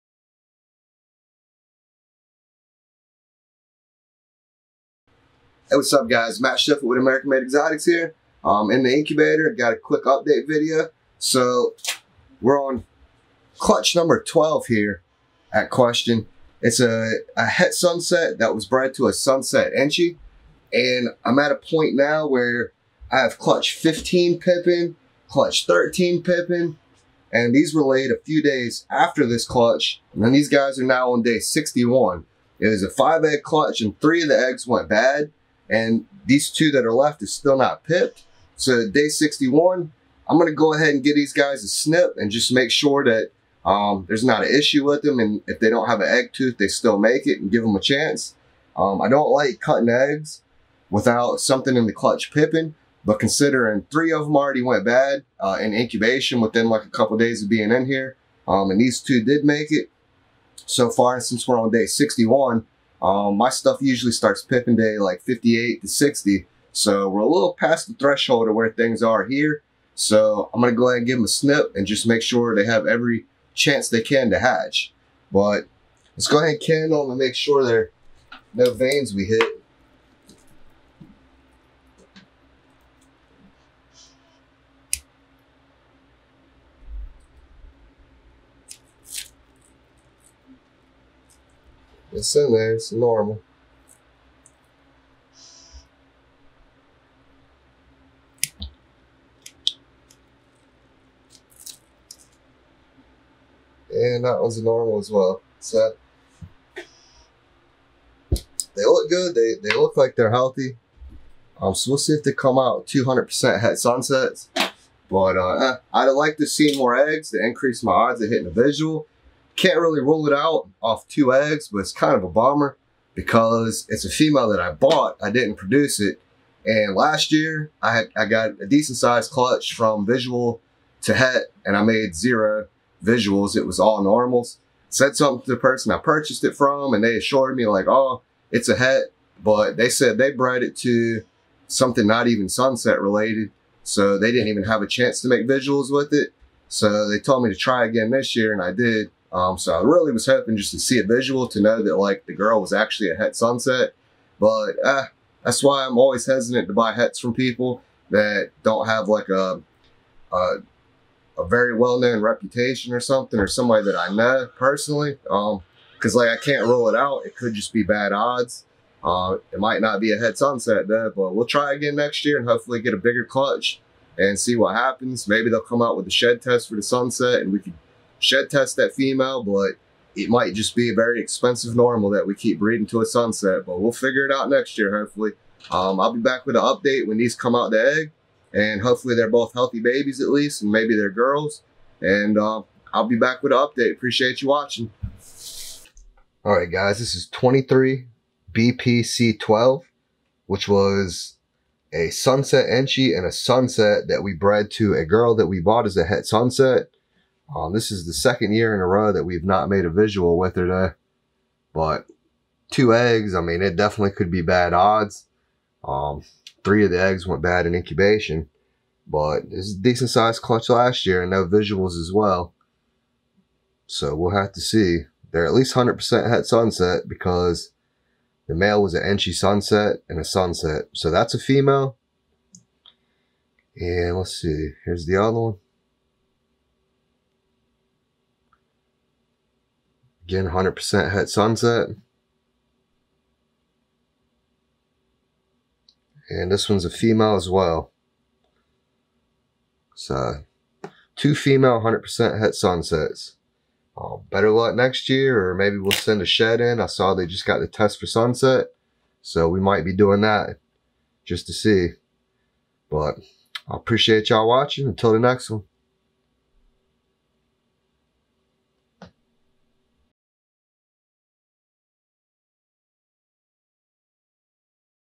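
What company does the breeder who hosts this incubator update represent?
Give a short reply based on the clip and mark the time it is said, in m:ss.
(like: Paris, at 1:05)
American Made Exotics, at 0:06.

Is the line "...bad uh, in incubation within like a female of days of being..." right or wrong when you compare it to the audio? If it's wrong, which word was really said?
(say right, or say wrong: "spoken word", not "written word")
wrong: "couple", not "female".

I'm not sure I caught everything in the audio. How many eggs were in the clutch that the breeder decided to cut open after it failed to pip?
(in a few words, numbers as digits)
5.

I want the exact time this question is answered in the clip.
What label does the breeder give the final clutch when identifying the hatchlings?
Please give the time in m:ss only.
3:17.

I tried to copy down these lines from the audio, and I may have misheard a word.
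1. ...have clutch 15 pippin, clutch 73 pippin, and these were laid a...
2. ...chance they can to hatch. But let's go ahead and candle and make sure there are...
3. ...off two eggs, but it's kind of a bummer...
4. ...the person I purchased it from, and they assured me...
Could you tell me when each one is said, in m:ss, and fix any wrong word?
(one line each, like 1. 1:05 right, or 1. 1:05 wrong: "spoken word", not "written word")
1. 0:23 wrong: "13", not "73"
2. 1:13 right
3. 2:00 right
4. 2:15 right.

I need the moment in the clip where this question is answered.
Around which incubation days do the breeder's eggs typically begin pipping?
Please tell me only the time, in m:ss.
1:05.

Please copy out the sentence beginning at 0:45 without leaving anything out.
And if they don't have an egg tooth, they still make it and give them a chance.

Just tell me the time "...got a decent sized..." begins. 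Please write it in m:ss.
2:08.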